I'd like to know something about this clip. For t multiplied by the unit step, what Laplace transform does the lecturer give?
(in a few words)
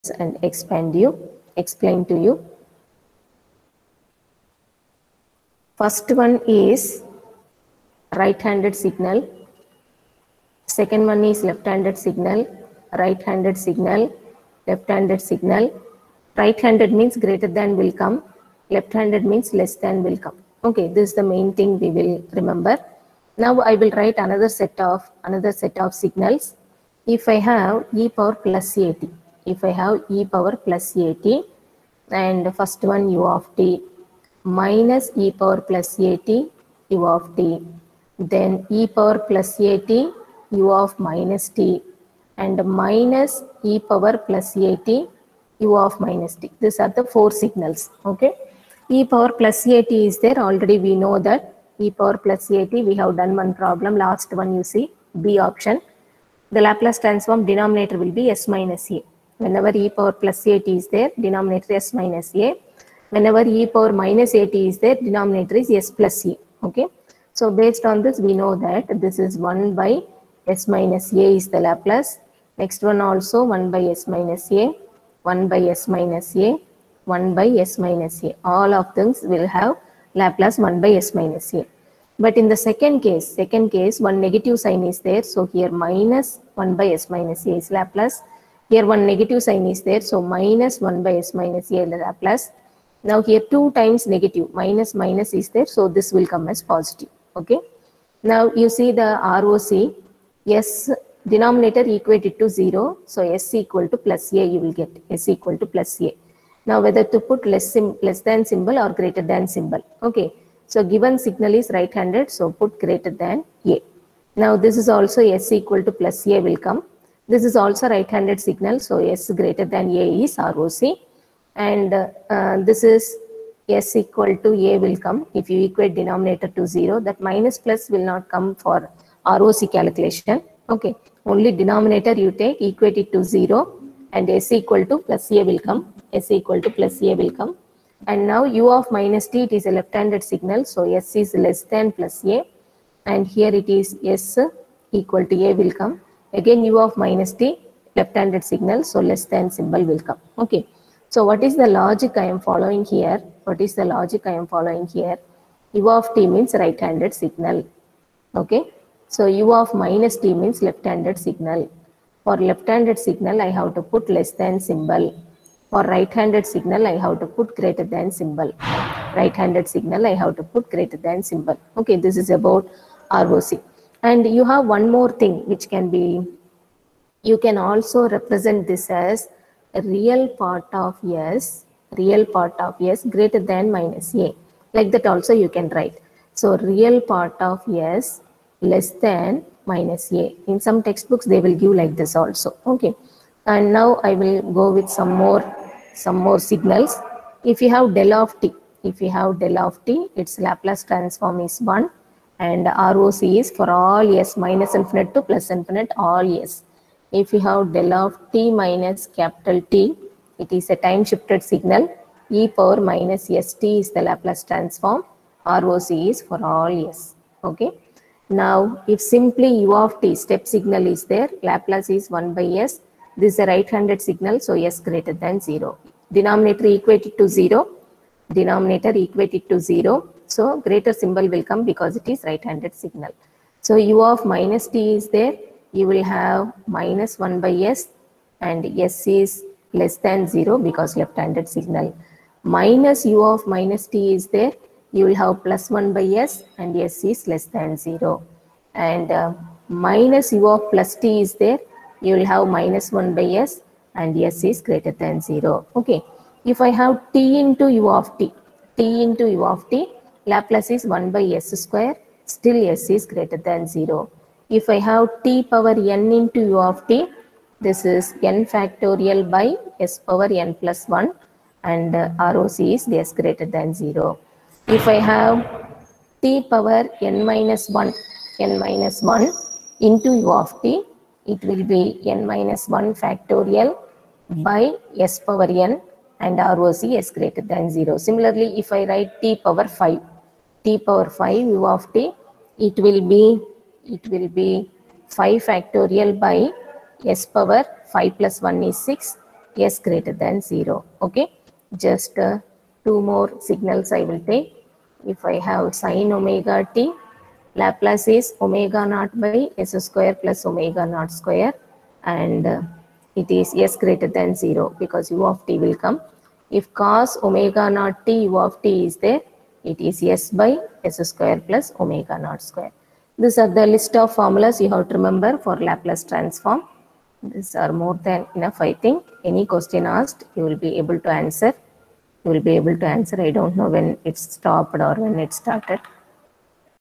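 1 by s square.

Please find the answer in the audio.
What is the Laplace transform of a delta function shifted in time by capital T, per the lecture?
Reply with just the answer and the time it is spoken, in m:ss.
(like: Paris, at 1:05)
e power minus st, at 3:32.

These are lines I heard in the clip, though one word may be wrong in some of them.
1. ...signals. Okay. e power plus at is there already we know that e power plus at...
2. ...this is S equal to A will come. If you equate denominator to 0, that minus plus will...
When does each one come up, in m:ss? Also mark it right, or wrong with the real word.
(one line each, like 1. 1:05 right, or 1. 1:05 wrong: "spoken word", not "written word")
1. 0:47 right
2. 2:02 right.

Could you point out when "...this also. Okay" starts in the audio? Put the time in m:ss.
3:11.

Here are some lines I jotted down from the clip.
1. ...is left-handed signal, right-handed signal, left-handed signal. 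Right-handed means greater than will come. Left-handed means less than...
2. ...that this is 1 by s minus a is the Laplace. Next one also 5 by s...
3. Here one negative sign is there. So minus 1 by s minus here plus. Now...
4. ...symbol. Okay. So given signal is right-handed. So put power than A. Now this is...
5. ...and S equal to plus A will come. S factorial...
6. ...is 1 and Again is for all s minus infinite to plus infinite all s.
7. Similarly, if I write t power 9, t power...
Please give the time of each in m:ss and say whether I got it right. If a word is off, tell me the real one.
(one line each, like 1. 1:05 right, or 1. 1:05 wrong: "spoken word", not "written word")
1. 0:11 right
2. 1:08 wrong: "1", not "5"
3. 1:28 right
4. 1:49 wrong: "greater", not "power"
5. 2:14 wrong: "equal", not "factorial"
6. 3:21 wrong: "ROC", not "Again"
7. 4:47 wrong: "5", not "9".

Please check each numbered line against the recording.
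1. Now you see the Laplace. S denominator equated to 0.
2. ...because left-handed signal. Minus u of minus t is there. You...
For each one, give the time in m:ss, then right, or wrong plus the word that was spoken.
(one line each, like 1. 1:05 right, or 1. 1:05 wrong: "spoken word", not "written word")
1. 1:38 wrong: "ROC", not "Laplace"
2. 4:00 right.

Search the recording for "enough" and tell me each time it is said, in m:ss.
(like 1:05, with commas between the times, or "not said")
5:28.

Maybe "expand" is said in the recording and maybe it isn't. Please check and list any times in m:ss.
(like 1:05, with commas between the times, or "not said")
0:00.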